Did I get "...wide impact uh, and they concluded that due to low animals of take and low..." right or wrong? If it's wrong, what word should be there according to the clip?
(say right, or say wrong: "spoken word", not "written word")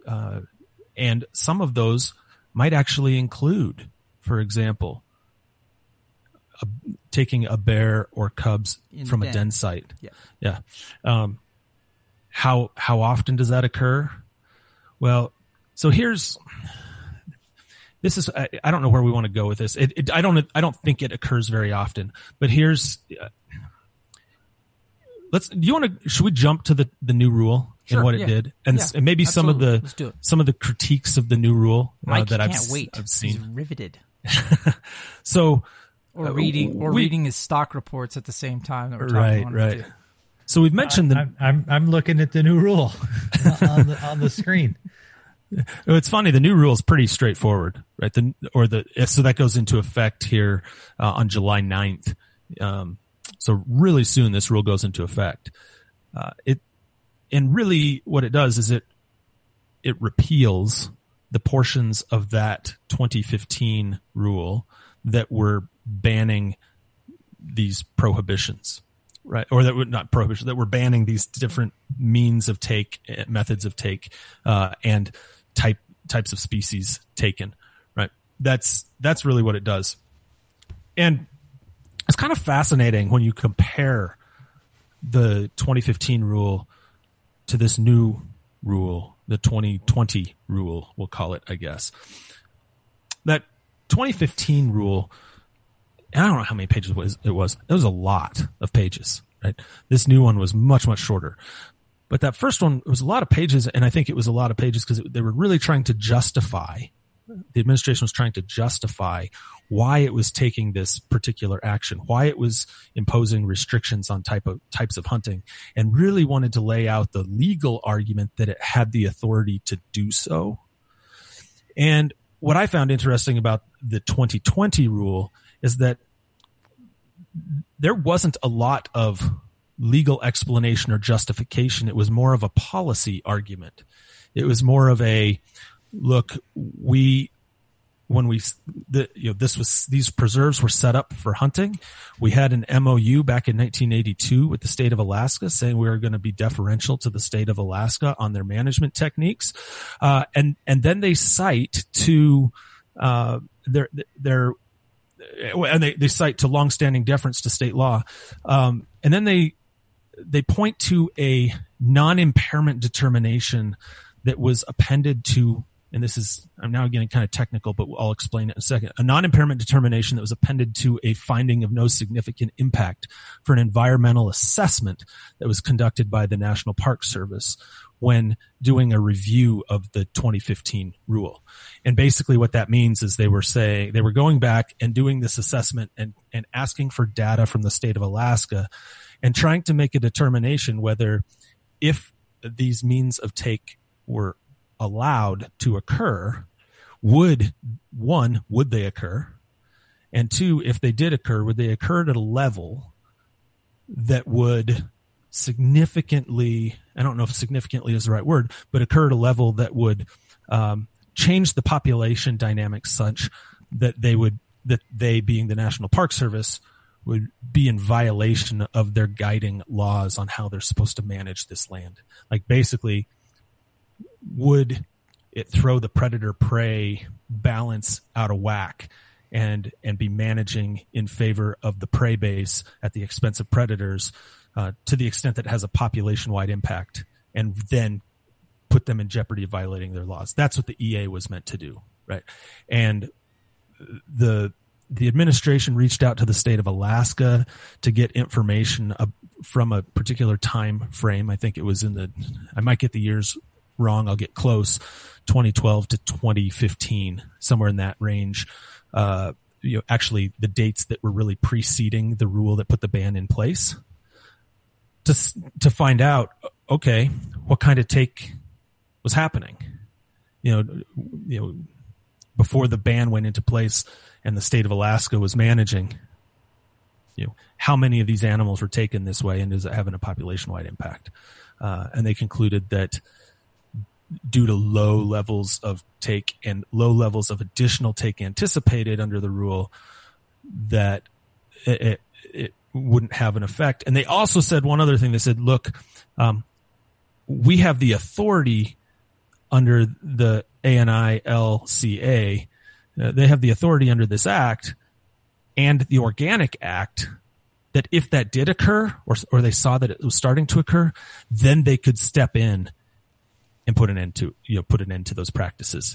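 wrong: "levels", not "animals".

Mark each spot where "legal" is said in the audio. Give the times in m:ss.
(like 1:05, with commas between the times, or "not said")
1:57, 2:09.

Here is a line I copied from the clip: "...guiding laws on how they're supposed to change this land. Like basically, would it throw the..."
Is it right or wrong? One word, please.
wrong.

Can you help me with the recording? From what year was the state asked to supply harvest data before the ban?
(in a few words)
2012.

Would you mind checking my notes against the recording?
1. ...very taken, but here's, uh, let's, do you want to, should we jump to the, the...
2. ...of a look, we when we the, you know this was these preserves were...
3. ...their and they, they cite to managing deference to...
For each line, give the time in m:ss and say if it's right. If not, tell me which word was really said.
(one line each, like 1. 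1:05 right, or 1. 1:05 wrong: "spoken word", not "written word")
1. 0:21 wrong: "often", not "taken"
2. 2:14 right
3. 2:34 wrong: "longstanding", not "managing".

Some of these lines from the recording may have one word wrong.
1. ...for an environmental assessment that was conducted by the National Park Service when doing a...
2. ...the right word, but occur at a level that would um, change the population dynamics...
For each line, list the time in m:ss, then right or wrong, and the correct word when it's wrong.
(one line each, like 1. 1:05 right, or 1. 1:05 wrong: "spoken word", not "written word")
1. 2:53 right
2. 3:28 right.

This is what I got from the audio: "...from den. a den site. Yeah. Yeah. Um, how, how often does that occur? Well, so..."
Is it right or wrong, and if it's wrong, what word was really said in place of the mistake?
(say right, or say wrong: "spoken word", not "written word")
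right.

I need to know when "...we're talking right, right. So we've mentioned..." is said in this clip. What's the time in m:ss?
0:38.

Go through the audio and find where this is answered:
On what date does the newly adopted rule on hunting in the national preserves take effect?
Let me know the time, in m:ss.
0:51.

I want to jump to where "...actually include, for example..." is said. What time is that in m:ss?
0:02.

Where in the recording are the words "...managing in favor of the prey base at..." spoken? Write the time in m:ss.
3:50.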